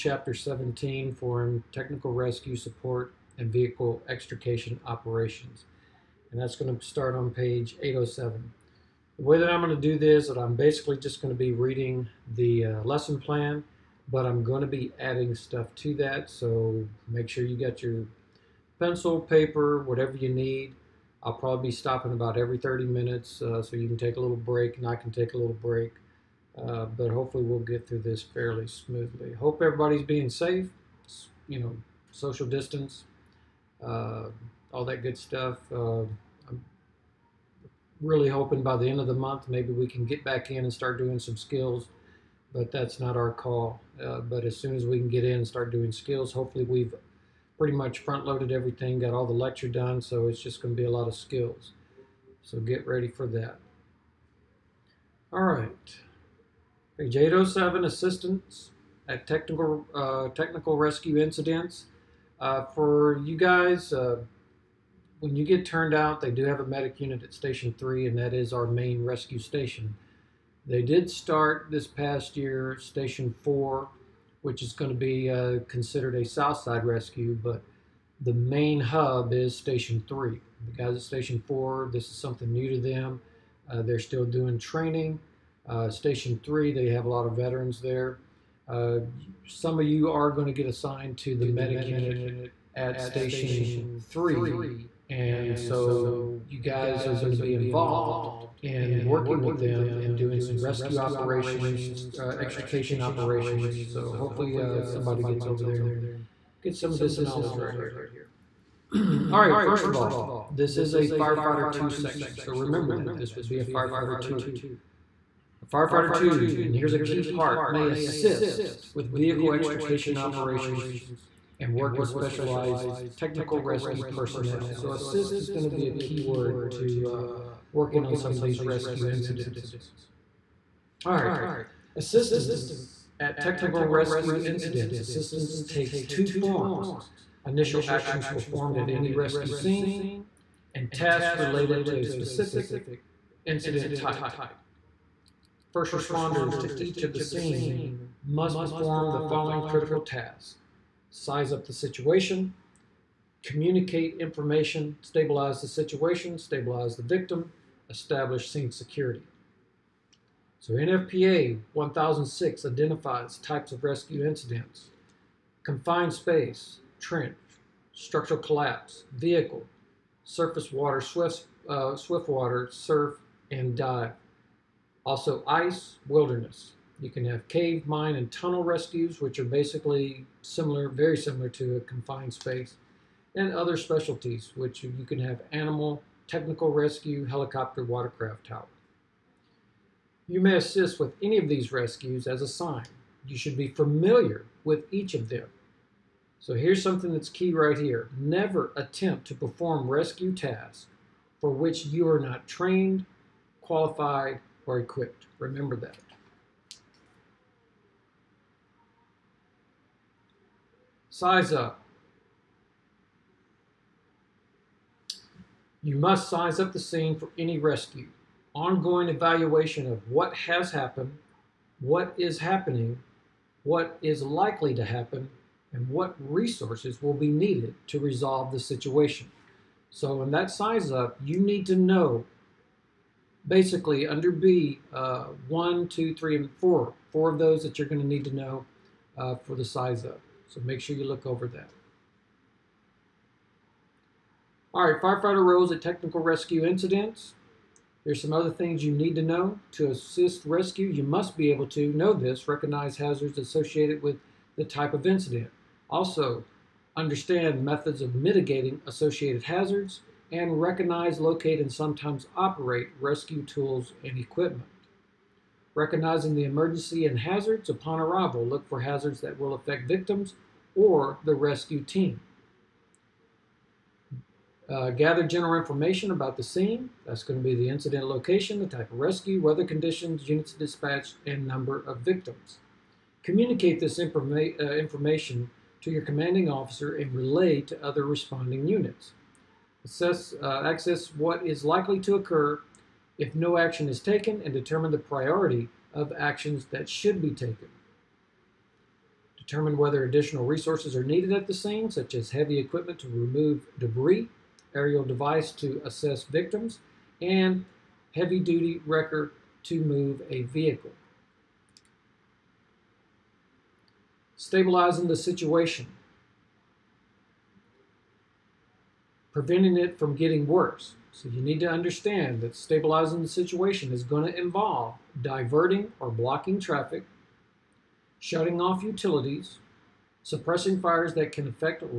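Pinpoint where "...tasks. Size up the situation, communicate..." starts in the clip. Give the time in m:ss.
2:30.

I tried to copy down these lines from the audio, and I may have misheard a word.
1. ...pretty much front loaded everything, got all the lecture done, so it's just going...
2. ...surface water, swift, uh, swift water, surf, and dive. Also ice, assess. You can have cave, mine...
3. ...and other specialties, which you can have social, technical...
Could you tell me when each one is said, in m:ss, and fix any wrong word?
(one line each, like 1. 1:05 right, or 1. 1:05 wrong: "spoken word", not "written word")
1. 0:47 right
2. 2:50 wrong: "wilderness", not "assess"
3. 3:03 wrong: "animal", not "social".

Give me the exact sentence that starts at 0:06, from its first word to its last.
And that's going to start on page 807.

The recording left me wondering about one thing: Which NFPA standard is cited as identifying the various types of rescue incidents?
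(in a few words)
NFPA 1006.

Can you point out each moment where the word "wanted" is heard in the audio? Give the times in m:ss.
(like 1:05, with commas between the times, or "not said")
not said.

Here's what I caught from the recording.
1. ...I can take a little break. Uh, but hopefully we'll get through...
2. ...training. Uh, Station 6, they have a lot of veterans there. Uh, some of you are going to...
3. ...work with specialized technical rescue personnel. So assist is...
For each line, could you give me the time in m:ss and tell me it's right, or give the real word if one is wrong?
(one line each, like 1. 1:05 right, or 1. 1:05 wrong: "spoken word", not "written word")
1. 0:24 right
2. 1:24 wrong: "3", not "6"
3. 2:01 right.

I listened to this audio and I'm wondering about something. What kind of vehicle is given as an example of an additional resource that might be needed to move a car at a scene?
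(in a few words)
heavy-duty wrecker.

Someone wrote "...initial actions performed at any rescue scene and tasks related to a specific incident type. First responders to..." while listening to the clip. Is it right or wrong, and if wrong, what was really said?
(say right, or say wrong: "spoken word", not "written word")
right.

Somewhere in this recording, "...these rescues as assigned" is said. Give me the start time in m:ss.
3:11.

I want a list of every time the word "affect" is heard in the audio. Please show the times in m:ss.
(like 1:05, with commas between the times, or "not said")
4:29, 5:31.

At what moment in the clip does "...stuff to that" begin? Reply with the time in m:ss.
0:15.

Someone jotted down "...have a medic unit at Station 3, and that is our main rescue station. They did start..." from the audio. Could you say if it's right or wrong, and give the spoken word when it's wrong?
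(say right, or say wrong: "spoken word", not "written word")
right.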